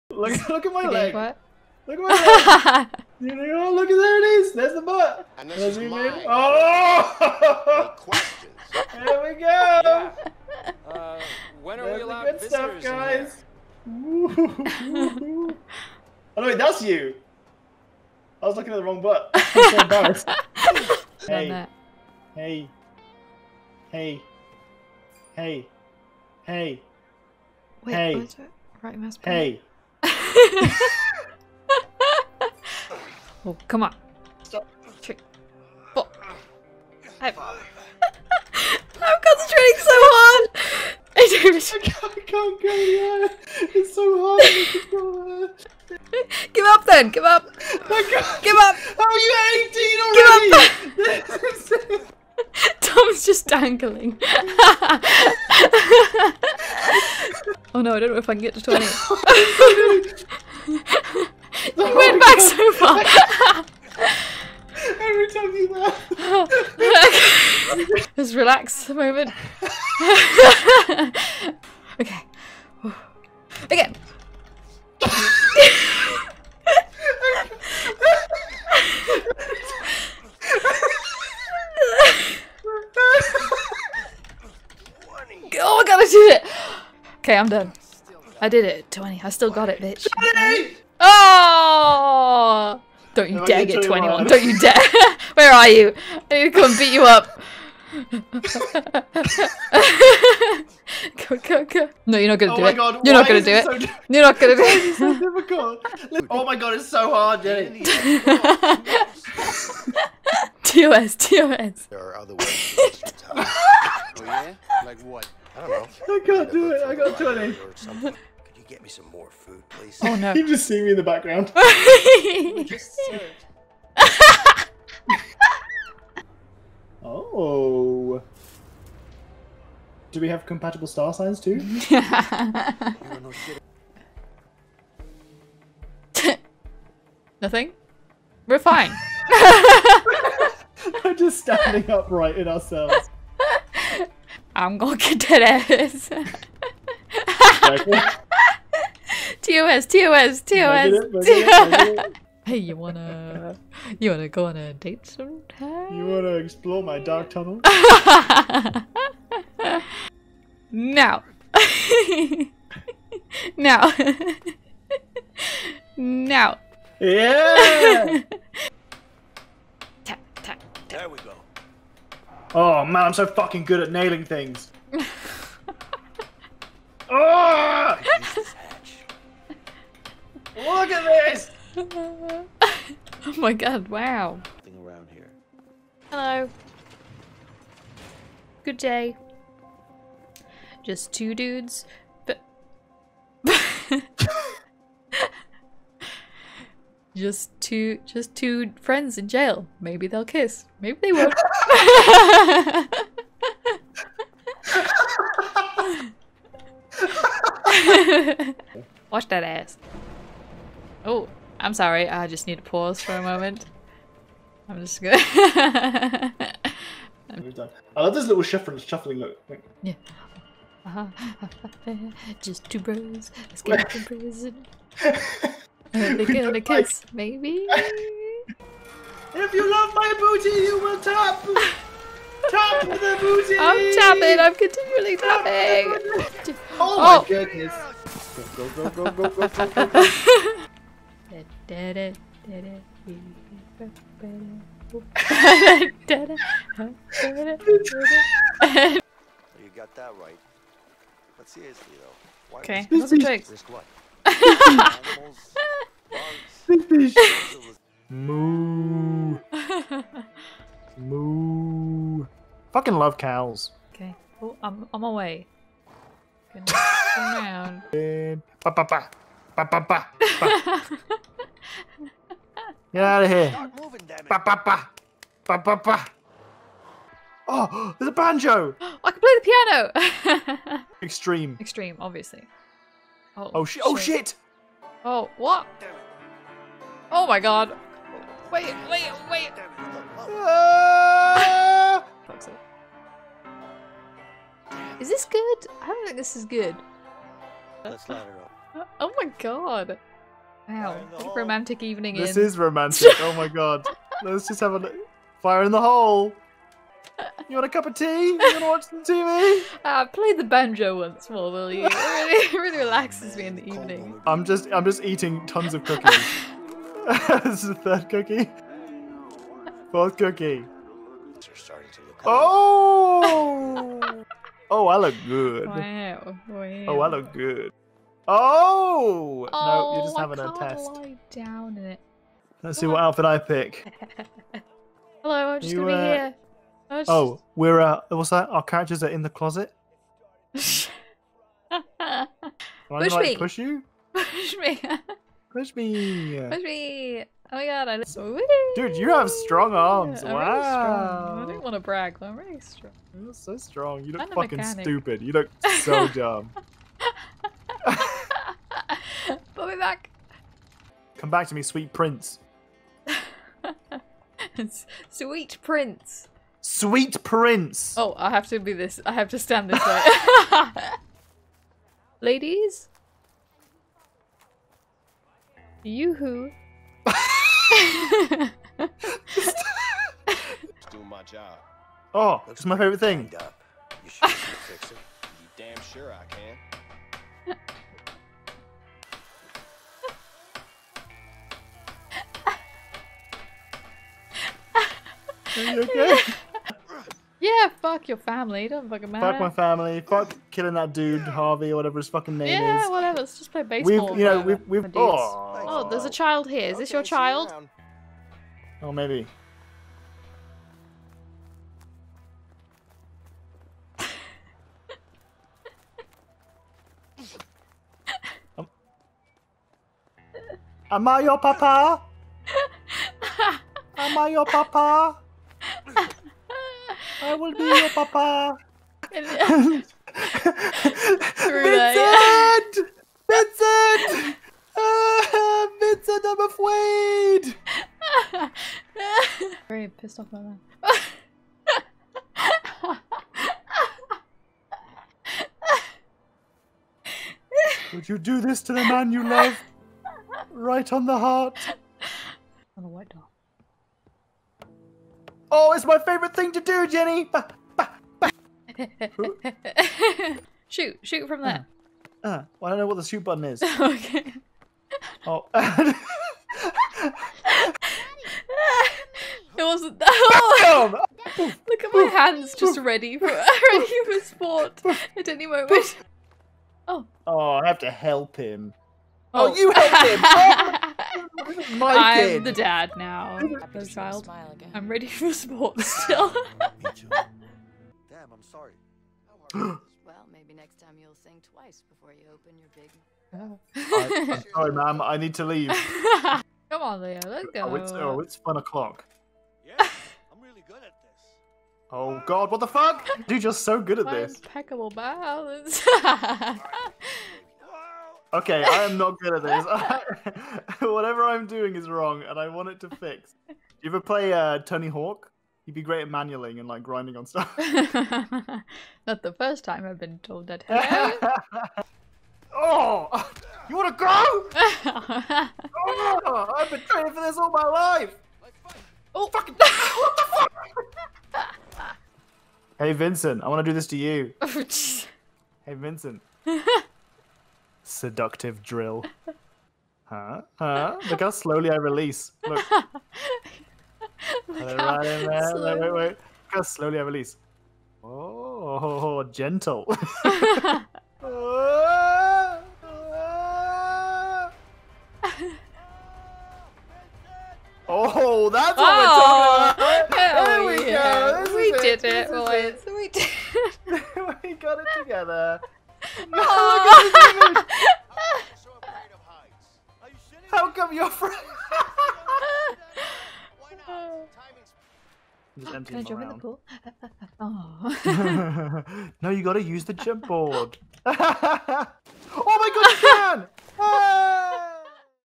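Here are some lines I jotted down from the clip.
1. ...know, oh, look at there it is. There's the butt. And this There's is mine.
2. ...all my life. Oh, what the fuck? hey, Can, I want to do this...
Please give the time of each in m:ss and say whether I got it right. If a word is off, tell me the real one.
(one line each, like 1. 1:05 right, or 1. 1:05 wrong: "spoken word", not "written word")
1. 0:03 wrong: "That", not "There"
2. 8:47 wrong: "Vincent", not "Can".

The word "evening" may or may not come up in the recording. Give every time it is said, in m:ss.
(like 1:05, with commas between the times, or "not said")
5:01, 5:13.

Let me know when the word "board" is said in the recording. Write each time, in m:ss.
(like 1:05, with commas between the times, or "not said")
9:40.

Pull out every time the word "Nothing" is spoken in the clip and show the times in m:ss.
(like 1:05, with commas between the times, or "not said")
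2:17.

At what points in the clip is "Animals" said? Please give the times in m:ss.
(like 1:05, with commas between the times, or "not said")
4:14.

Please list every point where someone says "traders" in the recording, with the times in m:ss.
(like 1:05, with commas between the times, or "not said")
not said.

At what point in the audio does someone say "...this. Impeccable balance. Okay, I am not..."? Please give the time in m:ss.
8:24.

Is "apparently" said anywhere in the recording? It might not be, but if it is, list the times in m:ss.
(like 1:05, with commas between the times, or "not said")
not said.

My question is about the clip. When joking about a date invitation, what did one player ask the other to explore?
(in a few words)
my dark tunnel.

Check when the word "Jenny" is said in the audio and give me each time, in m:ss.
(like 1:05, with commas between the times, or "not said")
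1:47, 7:36.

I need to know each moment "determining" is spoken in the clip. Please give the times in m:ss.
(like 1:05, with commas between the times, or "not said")
not said.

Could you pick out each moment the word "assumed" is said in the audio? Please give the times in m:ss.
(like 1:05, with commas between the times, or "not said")
not said.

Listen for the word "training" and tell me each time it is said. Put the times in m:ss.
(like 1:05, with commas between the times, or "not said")
8:46.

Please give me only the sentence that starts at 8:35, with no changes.
He'd be great at manualing and like grinding on stuff.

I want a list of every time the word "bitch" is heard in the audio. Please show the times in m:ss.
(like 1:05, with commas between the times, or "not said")
1:29.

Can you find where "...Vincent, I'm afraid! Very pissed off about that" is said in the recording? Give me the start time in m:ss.
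7:15.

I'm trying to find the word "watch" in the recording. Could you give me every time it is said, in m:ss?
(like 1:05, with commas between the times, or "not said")
3:29, 5:08.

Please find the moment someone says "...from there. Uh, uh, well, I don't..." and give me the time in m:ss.
7:41.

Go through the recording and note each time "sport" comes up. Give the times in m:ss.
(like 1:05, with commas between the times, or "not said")
7:54, 8:05.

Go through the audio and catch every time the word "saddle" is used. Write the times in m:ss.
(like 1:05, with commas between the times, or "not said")
not said.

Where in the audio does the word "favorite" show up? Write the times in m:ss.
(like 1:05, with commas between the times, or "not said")
6:22, 7:35.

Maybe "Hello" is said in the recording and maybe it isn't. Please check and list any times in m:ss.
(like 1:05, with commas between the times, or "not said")
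3:06, 5:35.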